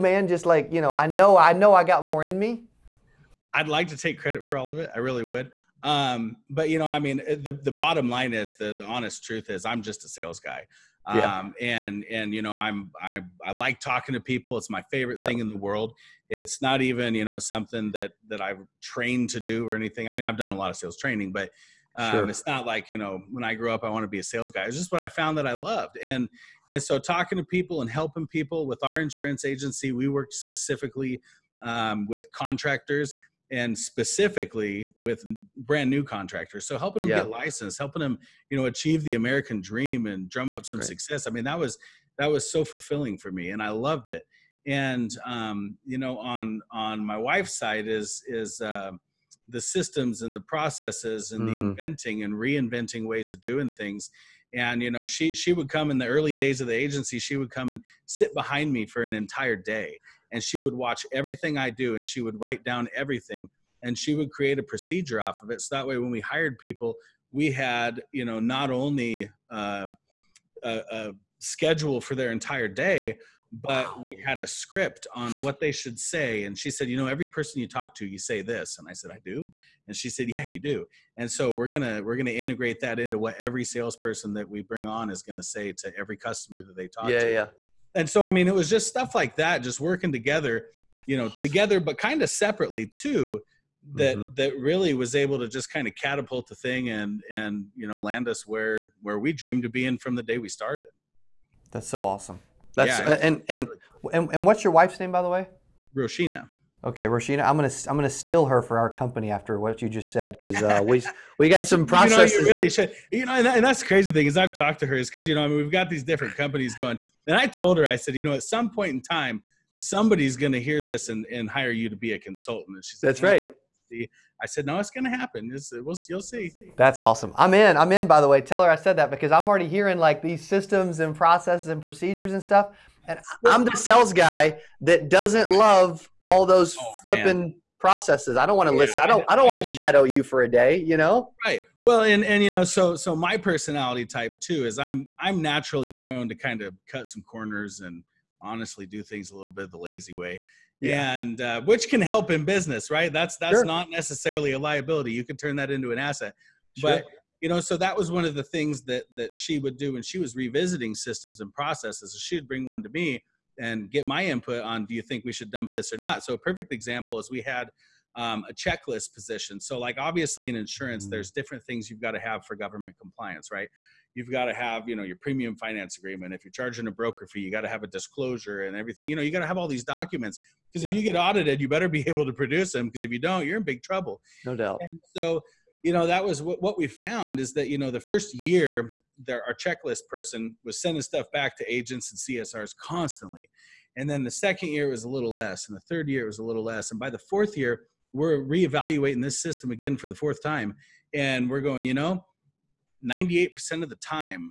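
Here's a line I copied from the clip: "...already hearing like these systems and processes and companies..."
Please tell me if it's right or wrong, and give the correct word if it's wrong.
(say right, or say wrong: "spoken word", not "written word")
wrong: "procedures", not "companies".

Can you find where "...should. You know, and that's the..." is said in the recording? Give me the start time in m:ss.
1:52.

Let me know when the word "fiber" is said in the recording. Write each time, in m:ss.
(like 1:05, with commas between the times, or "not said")
not said.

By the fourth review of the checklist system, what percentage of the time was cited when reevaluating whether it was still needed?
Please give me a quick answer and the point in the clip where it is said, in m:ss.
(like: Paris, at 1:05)
98%, at 3:23.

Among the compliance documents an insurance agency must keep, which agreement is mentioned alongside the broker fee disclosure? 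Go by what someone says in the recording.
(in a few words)
premium finance agreement.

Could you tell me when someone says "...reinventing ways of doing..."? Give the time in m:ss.
0:52.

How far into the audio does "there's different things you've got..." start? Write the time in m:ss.
2:51.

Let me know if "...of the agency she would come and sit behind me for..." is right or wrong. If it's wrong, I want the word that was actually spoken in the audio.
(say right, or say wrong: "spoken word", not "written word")
right.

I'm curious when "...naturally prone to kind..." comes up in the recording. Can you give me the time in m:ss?
2:25.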